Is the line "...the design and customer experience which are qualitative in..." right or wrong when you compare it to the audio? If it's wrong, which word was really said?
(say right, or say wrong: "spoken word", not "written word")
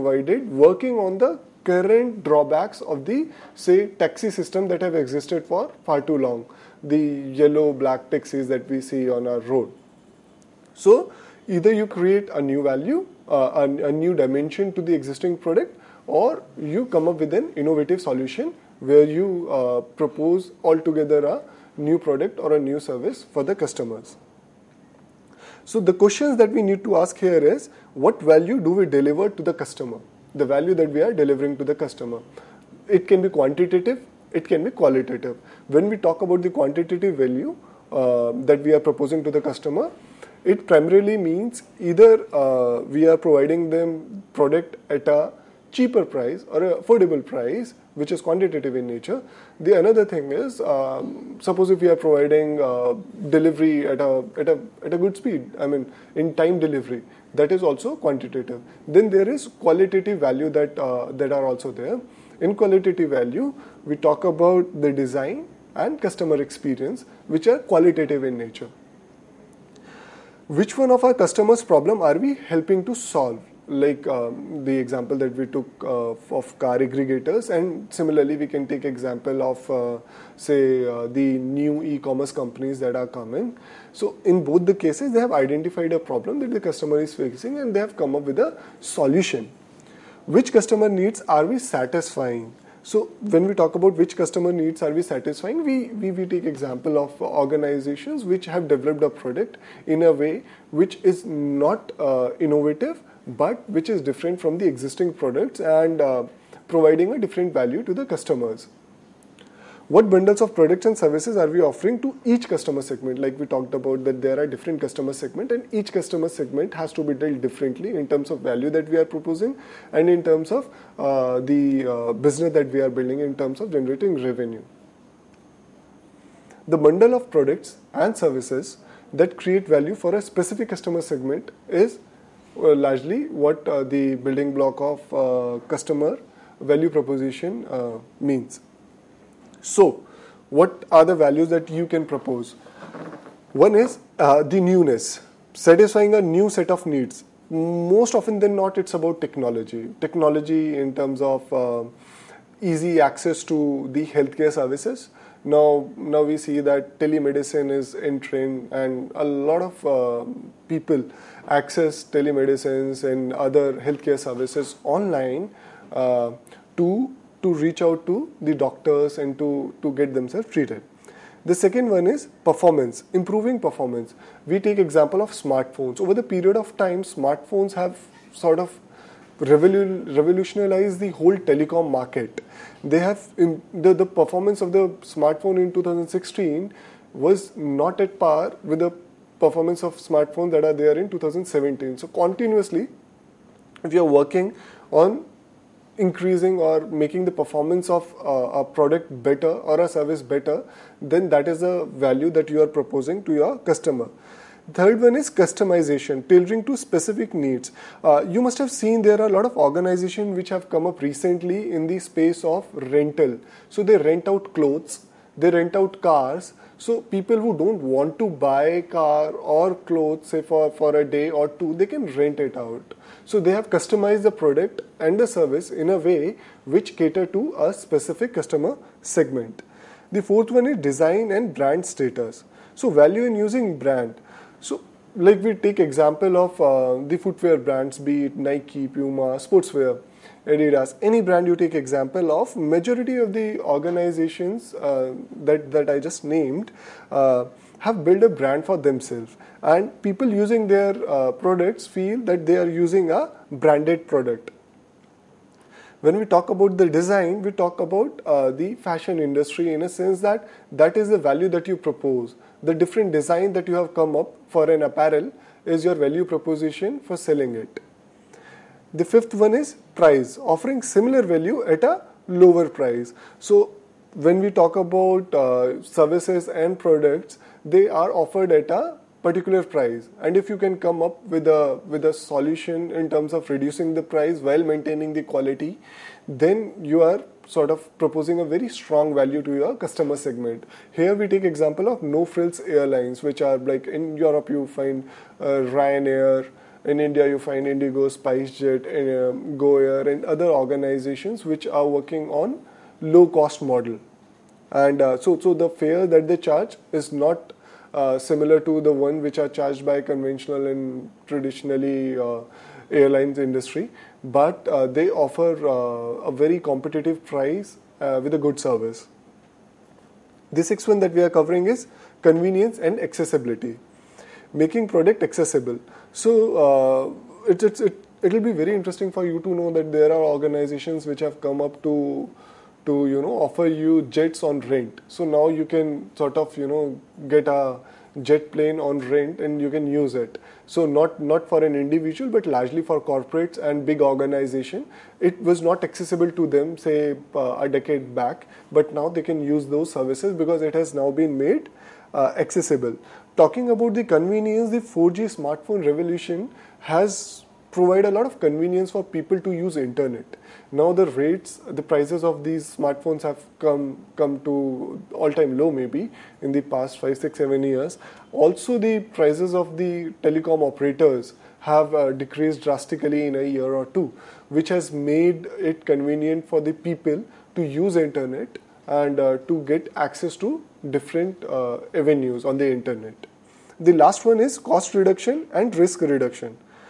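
right.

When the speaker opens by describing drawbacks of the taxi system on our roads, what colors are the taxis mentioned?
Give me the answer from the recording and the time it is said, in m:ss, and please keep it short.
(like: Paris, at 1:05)
yellow black, at 0:07.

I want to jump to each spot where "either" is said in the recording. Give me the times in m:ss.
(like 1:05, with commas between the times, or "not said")
0:11, 0:41.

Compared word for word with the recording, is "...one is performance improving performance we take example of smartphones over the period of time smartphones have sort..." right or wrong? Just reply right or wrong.
right.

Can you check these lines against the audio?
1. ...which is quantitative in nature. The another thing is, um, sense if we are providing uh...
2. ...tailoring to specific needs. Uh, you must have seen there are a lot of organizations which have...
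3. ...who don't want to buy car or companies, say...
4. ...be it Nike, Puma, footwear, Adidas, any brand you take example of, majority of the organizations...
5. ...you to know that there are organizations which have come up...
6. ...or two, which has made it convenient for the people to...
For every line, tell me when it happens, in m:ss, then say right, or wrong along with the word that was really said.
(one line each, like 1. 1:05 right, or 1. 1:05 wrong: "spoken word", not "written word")
1. 0:47 wrong: "suppose", not "sense"
2. 3:26 right
3. 3:37 wrong: "clothes", not "companies"
4. 3:57 wrong: "sportswear", not "footwear"
5. 5:29 right
6. 6:13 right.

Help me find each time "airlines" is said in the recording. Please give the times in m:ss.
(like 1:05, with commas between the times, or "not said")
4:52, 5:12.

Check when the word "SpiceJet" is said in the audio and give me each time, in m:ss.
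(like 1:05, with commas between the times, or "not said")
4:58.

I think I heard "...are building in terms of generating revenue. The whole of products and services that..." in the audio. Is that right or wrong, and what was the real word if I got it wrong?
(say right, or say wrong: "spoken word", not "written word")
wrong: "bundle", not "whole".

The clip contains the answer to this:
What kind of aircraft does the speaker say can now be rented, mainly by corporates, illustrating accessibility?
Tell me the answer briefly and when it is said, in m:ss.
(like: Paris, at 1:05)
jet plane, at 5:38.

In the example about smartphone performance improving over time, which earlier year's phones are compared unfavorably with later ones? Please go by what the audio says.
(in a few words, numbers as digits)
2016.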